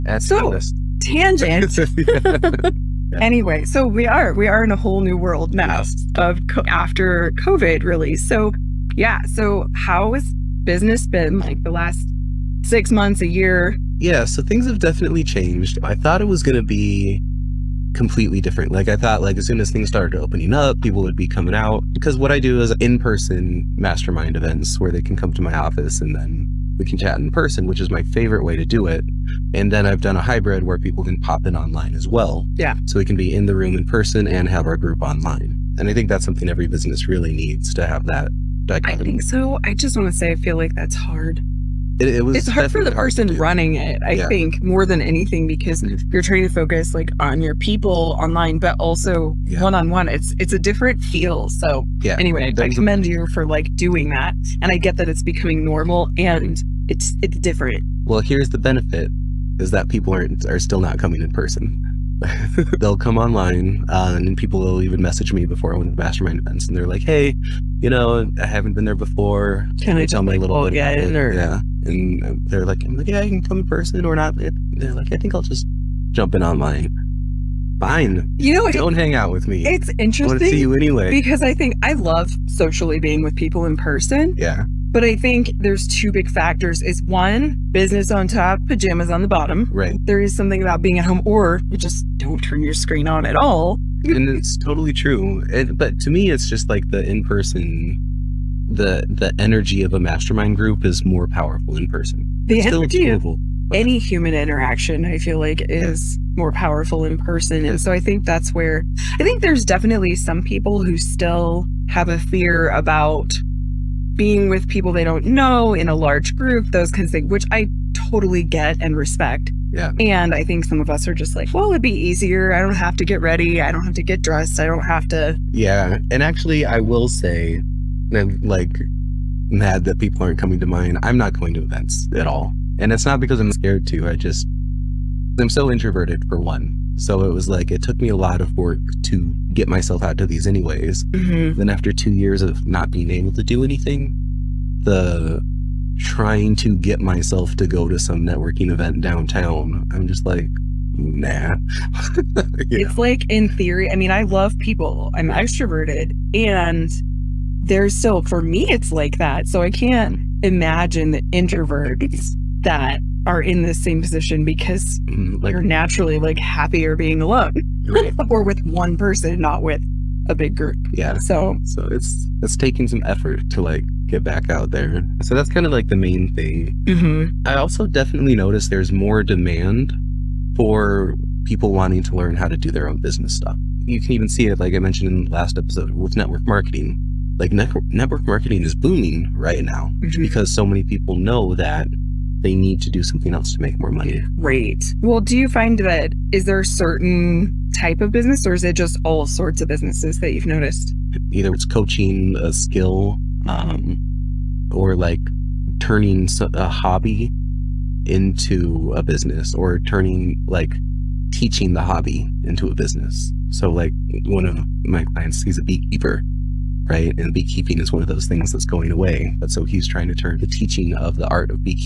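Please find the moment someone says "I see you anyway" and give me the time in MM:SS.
01:20.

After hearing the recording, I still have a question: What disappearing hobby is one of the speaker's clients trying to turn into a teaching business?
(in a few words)
Beekeeping.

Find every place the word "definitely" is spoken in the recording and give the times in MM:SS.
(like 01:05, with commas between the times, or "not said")
00:14, 01:49, 02:57.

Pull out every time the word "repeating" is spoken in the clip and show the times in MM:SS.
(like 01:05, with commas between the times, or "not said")
not said.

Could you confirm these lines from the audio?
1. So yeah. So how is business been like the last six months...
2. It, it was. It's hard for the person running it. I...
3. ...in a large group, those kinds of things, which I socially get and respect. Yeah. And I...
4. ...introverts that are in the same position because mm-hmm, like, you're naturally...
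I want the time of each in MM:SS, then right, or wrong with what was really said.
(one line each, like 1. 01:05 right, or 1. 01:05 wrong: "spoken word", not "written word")
1. 00:08 right
2. 00:41 right
3. 01:55 wrong: "totally", not "socially"
4. 02:41 right.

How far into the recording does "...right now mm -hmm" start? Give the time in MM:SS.
03:09.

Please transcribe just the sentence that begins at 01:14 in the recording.
They're like, I think I'll just jump in online.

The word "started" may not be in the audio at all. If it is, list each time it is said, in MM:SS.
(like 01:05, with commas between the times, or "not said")
00:19.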